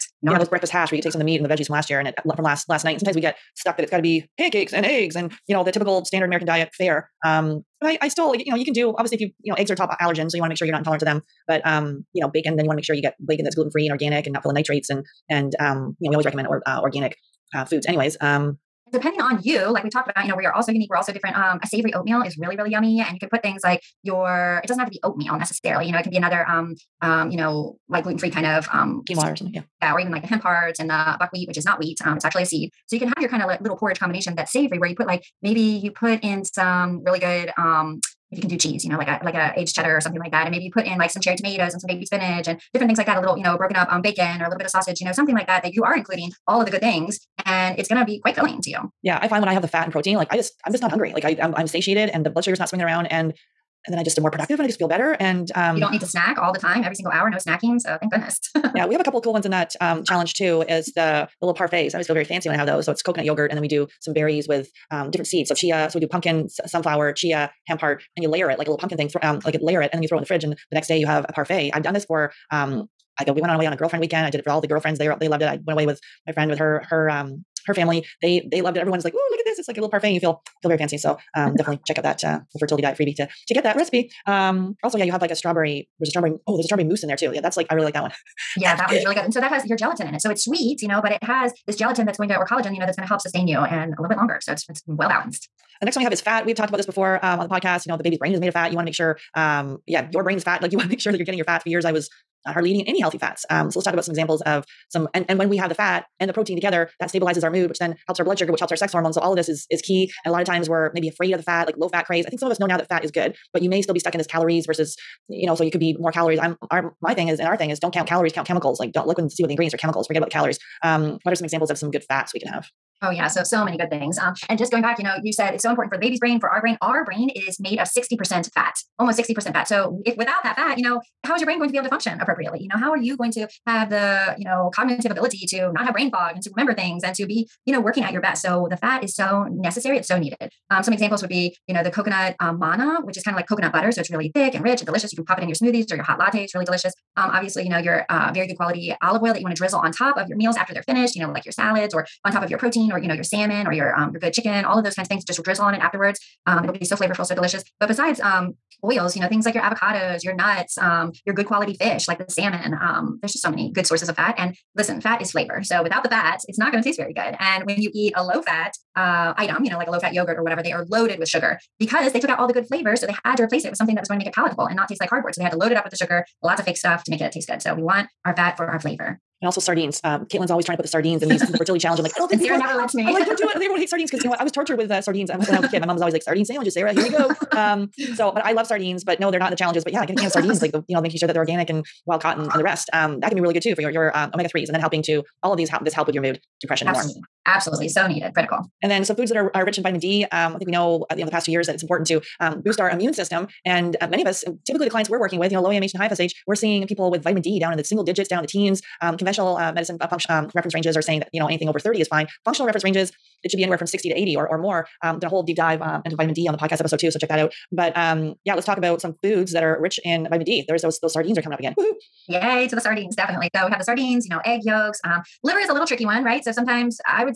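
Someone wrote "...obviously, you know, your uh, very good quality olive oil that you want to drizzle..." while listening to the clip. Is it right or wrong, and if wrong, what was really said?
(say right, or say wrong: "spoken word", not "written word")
right.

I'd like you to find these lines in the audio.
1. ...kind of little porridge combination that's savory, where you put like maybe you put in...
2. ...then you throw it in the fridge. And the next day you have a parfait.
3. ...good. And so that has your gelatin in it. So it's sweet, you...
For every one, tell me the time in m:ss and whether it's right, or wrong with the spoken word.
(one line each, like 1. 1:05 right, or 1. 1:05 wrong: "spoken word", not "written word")
1. 0:33 right
2. 1:09 right
3. 1:29 right.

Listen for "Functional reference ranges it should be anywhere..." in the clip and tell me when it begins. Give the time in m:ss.
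3:32.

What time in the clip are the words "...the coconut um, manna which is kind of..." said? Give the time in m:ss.
2:21.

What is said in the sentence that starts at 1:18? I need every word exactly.
Everyone's like, "Ooh, look at this!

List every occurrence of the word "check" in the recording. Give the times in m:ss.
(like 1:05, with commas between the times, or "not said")
1:21, 3:37.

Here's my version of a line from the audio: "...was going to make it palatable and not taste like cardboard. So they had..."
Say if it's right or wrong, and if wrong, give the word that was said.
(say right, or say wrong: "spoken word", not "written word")
right.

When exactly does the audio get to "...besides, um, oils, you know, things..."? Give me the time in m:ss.
2:37.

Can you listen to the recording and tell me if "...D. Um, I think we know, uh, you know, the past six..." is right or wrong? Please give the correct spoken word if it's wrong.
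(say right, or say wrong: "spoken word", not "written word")
wrong: "two", not "six".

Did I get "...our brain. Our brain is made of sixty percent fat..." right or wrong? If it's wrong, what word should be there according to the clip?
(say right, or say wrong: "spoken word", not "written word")
right.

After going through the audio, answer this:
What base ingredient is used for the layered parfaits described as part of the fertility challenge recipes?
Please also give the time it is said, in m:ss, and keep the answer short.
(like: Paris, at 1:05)
coconut yogurt, at 1:03.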